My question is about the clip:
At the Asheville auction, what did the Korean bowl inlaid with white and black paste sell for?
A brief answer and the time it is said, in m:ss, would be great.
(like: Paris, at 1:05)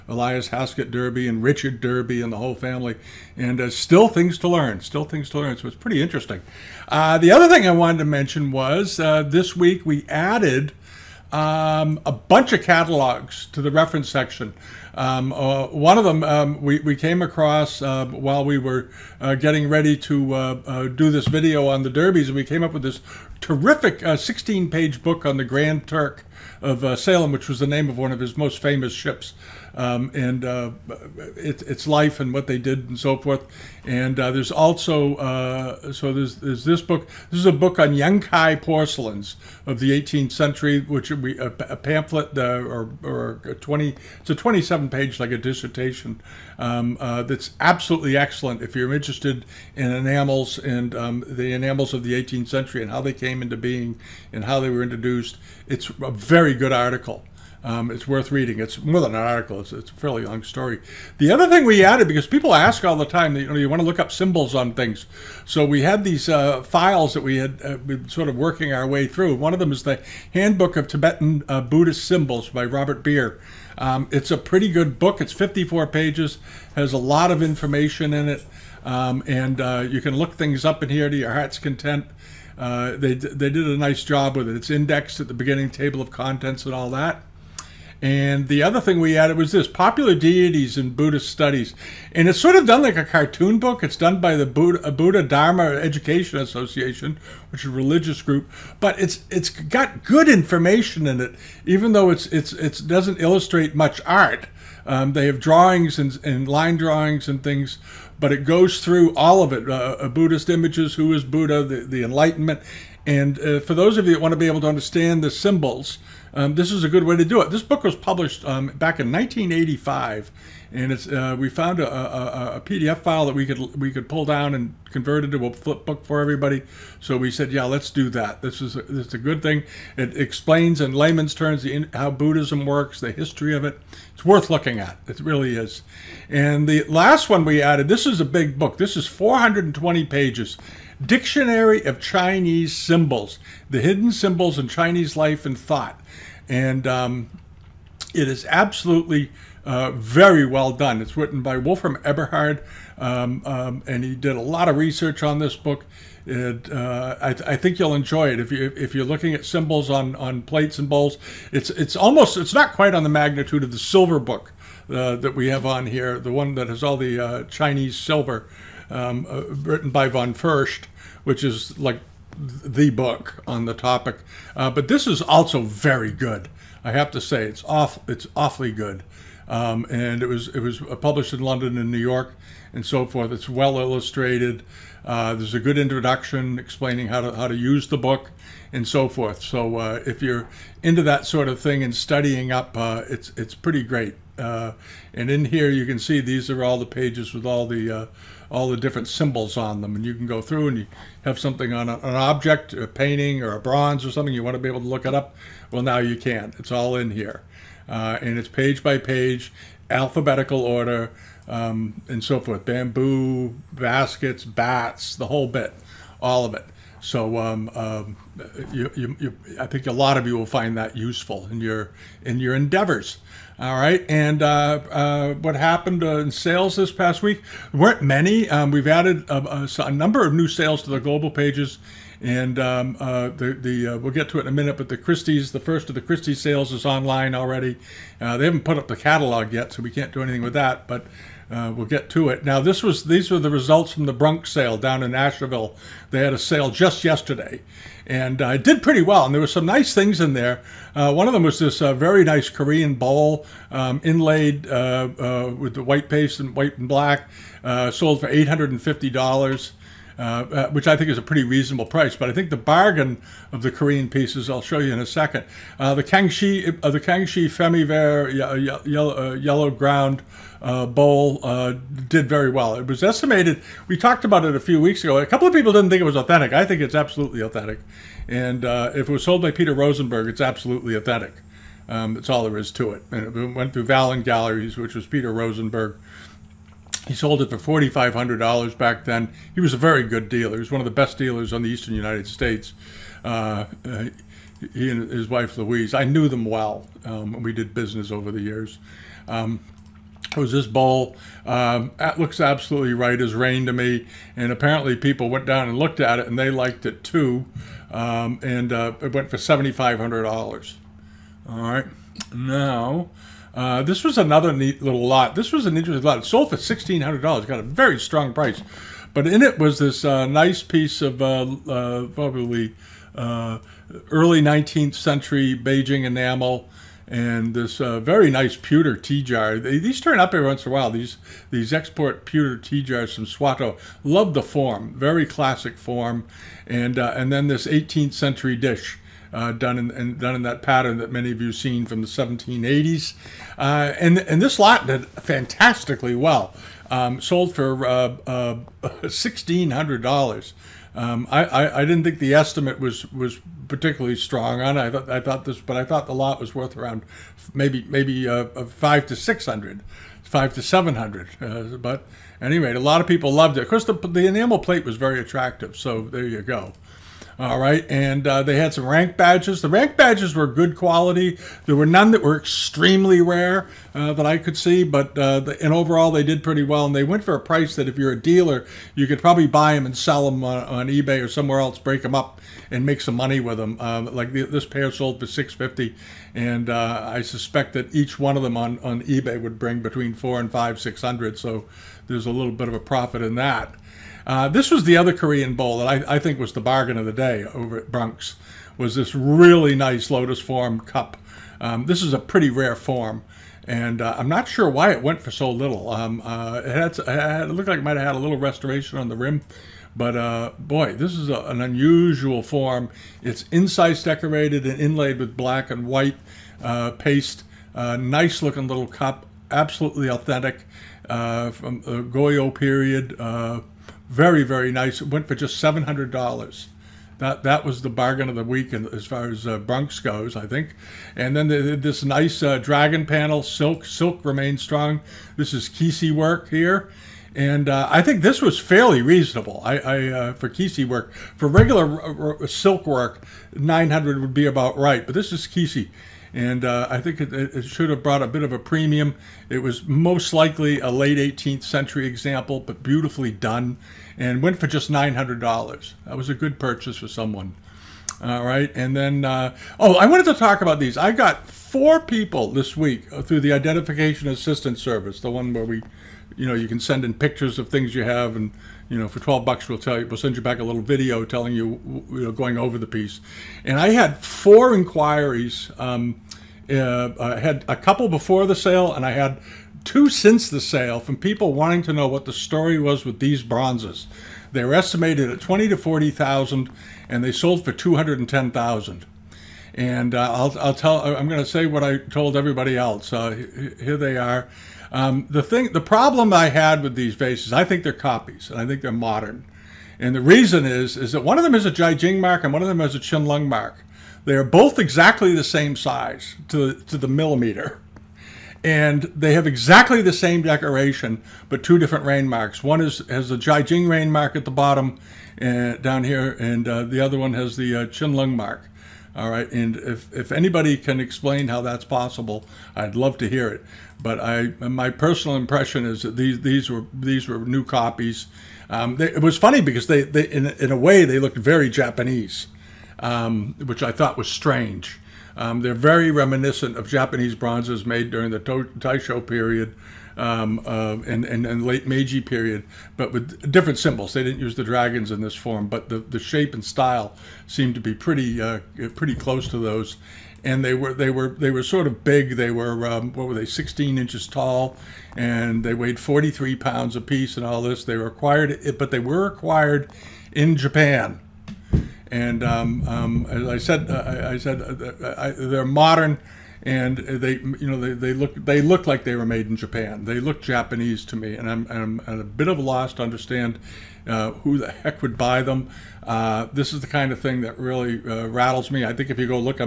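$850, at 4:18.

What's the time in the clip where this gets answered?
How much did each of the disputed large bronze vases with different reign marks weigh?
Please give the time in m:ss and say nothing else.
9:15.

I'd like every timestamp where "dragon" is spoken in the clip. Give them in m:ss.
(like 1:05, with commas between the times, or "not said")
7:12, 9:04.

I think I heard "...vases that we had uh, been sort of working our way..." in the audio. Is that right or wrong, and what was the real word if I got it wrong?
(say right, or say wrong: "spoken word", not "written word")
wrong: "files", not "vases".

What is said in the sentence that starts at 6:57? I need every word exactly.
nice looking little cup, absolutely authentic from the Goryeo period.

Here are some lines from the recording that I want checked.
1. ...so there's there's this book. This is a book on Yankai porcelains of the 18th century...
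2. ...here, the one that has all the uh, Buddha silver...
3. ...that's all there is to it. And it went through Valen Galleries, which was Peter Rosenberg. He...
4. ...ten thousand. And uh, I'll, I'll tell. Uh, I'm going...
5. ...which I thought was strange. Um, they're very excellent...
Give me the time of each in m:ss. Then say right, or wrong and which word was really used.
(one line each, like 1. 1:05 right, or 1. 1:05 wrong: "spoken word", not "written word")
1. 0:35 right
2. 2:45 wrong: "Chinese", not "Buddha"
3. 4:42 right
4. 8:08 right
5. 8:53 wrong: "reminiscent", not "excellent".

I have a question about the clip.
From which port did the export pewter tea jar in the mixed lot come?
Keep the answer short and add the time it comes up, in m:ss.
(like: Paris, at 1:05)
Swatow, at 5:33.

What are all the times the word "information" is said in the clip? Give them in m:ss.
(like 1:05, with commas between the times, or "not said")
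1:17, 1:40.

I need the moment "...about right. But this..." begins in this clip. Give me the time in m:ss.
7:24.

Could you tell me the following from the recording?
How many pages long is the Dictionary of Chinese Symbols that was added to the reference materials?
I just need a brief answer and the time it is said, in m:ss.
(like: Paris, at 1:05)
420, at 2:19.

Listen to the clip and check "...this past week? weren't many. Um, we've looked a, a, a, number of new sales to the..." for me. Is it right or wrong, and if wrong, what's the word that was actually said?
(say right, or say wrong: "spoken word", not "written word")
wrong: "added", not "looked".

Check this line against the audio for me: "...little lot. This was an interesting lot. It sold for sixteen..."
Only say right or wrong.
right.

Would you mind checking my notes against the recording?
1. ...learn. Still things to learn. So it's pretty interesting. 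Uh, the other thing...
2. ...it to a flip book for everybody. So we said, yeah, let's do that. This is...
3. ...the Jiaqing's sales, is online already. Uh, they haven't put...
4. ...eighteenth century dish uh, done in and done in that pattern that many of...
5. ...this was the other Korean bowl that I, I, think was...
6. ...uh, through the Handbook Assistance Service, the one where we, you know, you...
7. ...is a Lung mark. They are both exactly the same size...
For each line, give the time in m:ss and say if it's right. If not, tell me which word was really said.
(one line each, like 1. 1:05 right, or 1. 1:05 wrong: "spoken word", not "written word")
1. 0:04 right
2. 2:05 right
3. 3:55 wrong: "Christie", not "Jiaqing"
4. 5:37 right
5. 6:34 right
6. 7:43 wrong: "Identification", not "Handbook"
7. 8:22 right.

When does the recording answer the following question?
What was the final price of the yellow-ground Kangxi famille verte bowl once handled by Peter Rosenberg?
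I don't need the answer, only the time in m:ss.
5:09.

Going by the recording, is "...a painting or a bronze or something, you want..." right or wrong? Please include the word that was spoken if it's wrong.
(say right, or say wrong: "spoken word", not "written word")
right.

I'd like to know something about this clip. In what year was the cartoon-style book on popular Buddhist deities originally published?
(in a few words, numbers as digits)
1985.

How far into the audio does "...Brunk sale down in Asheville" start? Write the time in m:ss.
4:04.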